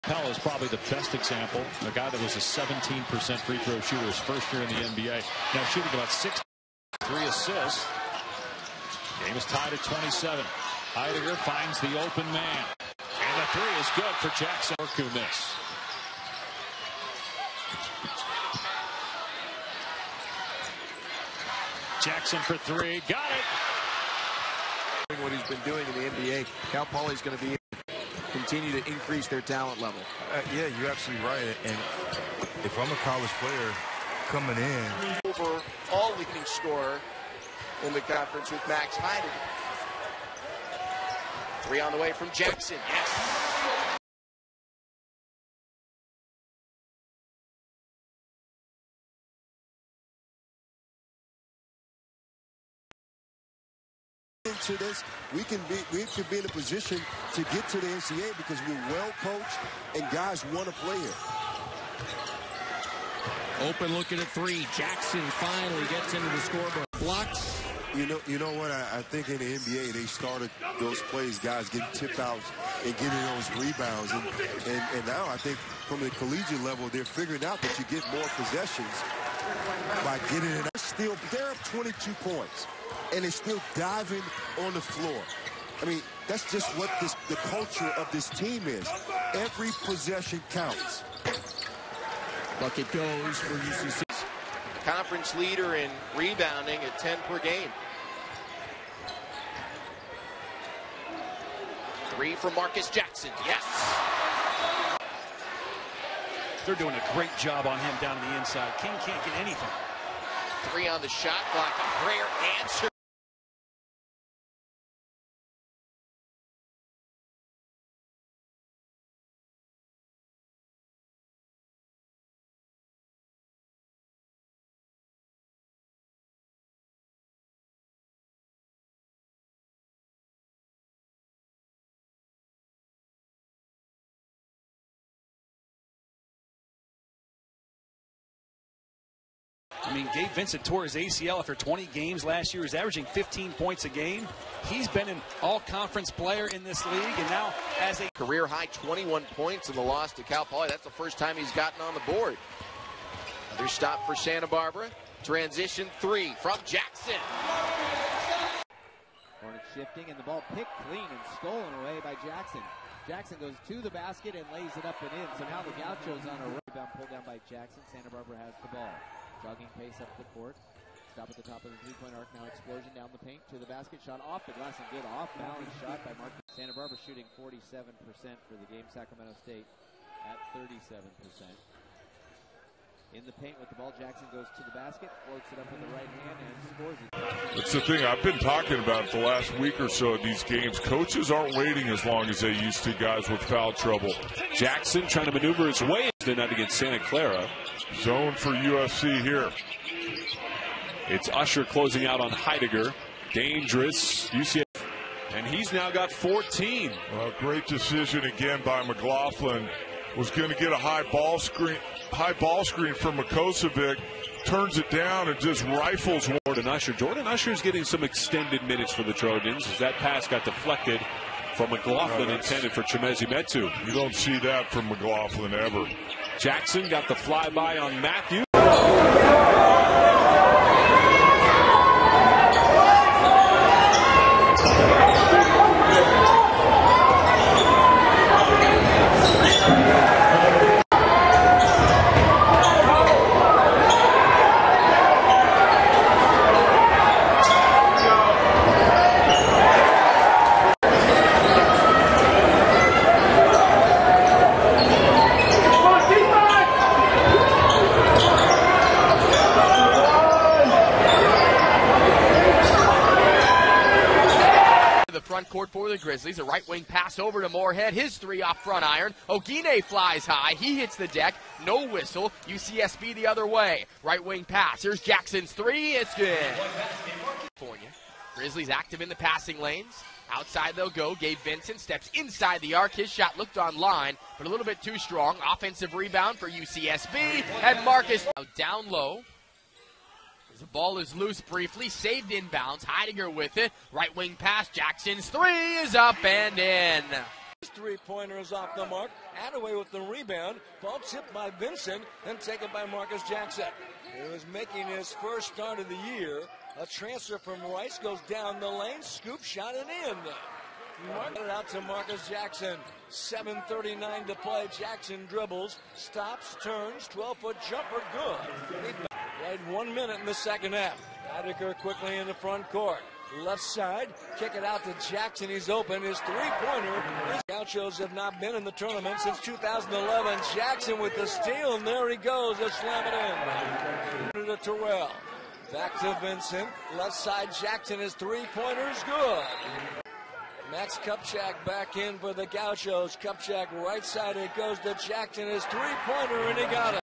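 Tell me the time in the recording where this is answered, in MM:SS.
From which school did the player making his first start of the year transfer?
05:07.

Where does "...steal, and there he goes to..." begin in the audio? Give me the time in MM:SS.
05:31.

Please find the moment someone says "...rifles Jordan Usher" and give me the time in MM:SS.
03:35.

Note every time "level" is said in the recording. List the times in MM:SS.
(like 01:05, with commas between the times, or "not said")
00:29, 01:16.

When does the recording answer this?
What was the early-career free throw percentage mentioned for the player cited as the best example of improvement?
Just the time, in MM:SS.
00:02.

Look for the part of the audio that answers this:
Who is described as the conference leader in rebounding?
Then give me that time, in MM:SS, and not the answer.
01:36.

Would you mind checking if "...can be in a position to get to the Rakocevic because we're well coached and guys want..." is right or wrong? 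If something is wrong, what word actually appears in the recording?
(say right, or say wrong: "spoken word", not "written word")
wrong: "NCAA", not "Rakocevic".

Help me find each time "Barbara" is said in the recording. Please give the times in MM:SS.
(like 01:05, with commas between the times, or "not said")
02:34, 02:48, 02:56.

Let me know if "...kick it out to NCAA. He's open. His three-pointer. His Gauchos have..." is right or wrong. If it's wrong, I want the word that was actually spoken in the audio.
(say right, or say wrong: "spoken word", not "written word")
wrong: "Jackson", not "NCAA".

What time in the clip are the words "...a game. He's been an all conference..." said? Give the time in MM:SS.
02:23.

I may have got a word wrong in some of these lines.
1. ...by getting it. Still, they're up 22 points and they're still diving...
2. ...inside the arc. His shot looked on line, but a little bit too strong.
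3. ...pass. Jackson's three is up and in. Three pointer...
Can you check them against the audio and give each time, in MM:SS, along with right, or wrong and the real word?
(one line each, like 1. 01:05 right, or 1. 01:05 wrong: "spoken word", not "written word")
1. 01:20 right
2. 04:42 right
3. 04:54 right.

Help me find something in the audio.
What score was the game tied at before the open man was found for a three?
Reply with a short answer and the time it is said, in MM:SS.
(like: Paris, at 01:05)
27, at 00:09.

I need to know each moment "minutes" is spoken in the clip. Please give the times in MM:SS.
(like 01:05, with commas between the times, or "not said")
03:38, 05:19.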